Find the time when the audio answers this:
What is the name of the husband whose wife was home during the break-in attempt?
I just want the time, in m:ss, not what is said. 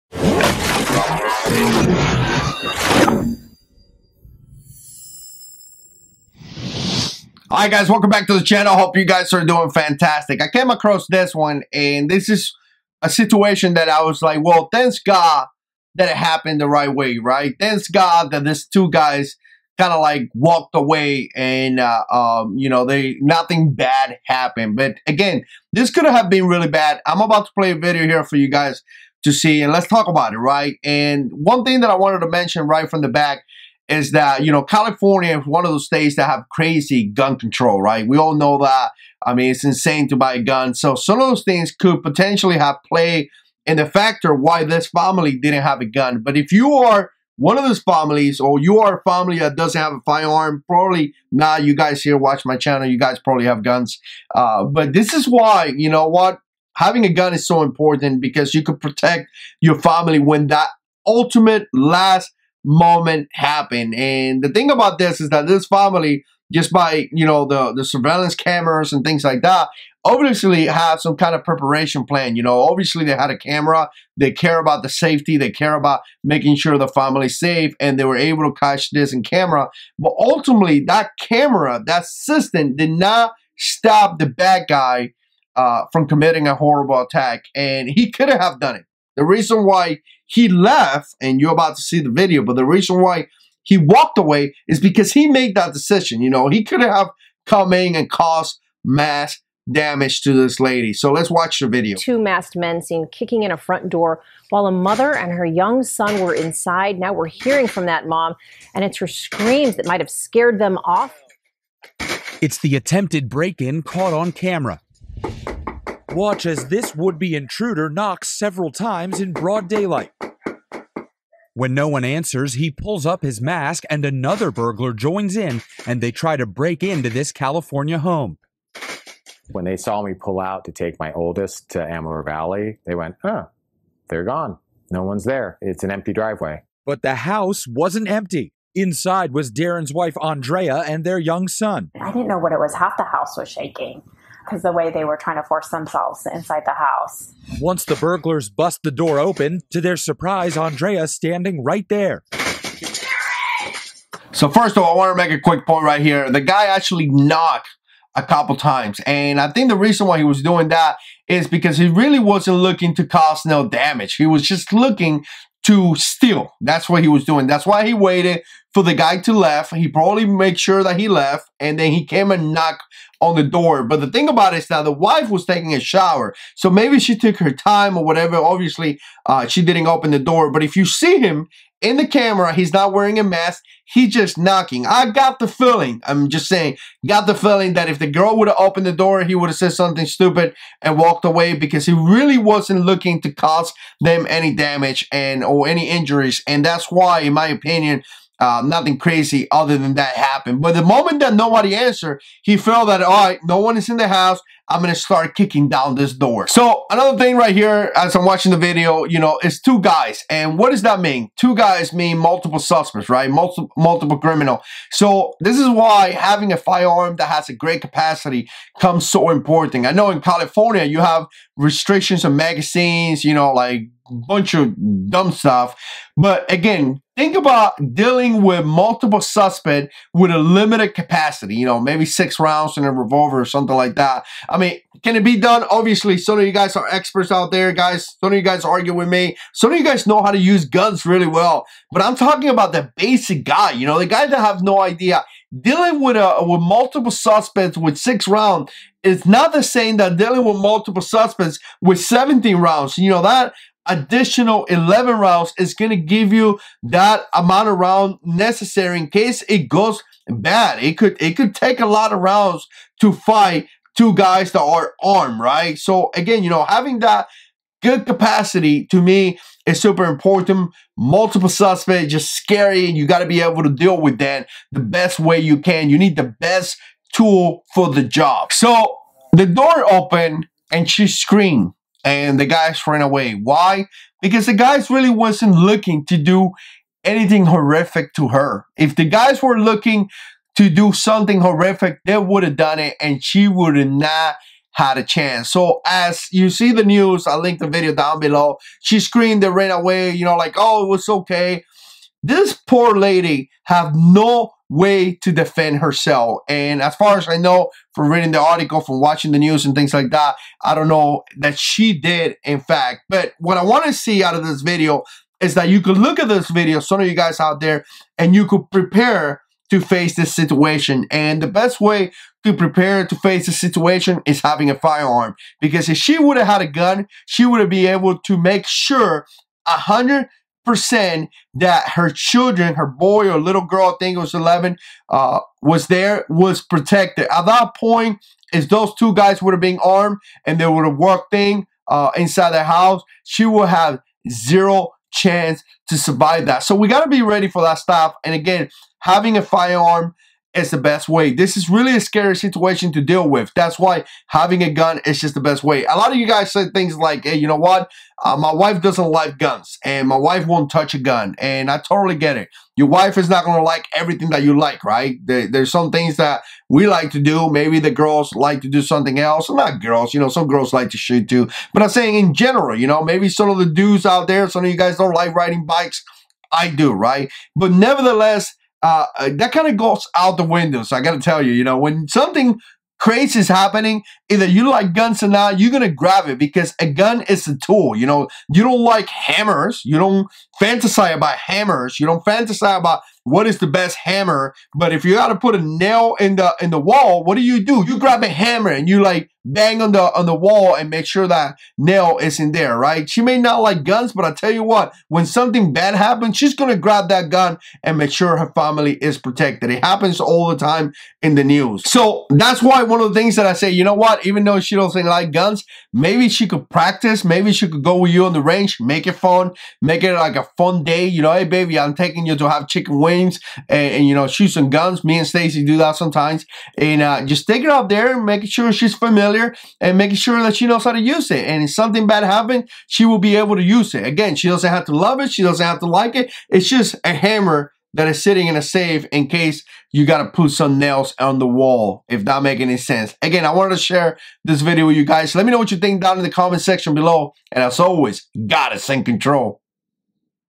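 2:19.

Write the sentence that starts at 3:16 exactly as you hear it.
And that's why, in my opinion, uh, nothing crazy other than that happened.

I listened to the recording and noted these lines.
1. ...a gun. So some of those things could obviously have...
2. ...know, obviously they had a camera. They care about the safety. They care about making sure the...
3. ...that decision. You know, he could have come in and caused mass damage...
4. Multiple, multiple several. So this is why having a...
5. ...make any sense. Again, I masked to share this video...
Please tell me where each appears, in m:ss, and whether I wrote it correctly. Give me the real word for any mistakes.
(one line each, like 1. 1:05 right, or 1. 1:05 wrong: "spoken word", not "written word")
1. 0:40 wrong: "potentially", not "obviously"
2. 1:12 right
3. 1:35 right
4. 3:33 wrong: "criminal", not "several"
5. 7:22 wrong: "wanted", not "masked".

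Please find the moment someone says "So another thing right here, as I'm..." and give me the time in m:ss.
3:26.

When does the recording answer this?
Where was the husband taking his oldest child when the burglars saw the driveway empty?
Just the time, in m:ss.
2:11.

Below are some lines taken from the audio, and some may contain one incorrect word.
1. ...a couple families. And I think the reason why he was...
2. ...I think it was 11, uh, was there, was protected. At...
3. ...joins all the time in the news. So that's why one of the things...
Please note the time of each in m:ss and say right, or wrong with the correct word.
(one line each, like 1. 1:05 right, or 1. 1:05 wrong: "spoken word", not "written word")
1. 2:38 wrong: "times", not "families"
2. 5:33 right
3. 6:49 wrong: "happens", not "joins".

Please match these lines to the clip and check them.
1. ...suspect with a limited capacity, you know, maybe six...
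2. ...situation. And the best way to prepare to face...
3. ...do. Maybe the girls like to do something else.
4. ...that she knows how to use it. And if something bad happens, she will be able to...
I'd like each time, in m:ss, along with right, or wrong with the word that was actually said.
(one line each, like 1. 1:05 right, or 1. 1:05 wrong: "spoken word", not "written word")
1. 3:49 right
2. 5:20 right
3. 6:07 right
4. 7:10 right.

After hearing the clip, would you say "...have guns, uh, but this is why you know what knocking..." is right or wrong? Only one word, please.
wrong.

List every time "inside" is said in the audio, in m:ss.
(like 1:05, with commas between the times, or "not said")
1:46, 2:18, 2:26, 5:42.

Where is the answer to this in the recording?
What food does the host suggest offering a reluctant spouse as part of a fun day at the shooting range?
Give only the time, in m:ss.
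7:02.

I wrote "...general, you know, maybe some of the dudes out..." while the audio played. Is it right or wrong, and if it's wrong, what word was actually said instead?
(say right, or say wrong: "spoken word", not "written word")
right.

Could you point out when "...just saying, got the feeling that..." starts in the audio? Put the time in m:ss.
3:06.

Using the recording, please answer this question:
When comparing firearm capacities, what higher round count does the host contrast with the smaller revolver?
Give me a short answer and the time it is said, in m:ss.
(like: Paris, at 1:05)
17, at 4:11.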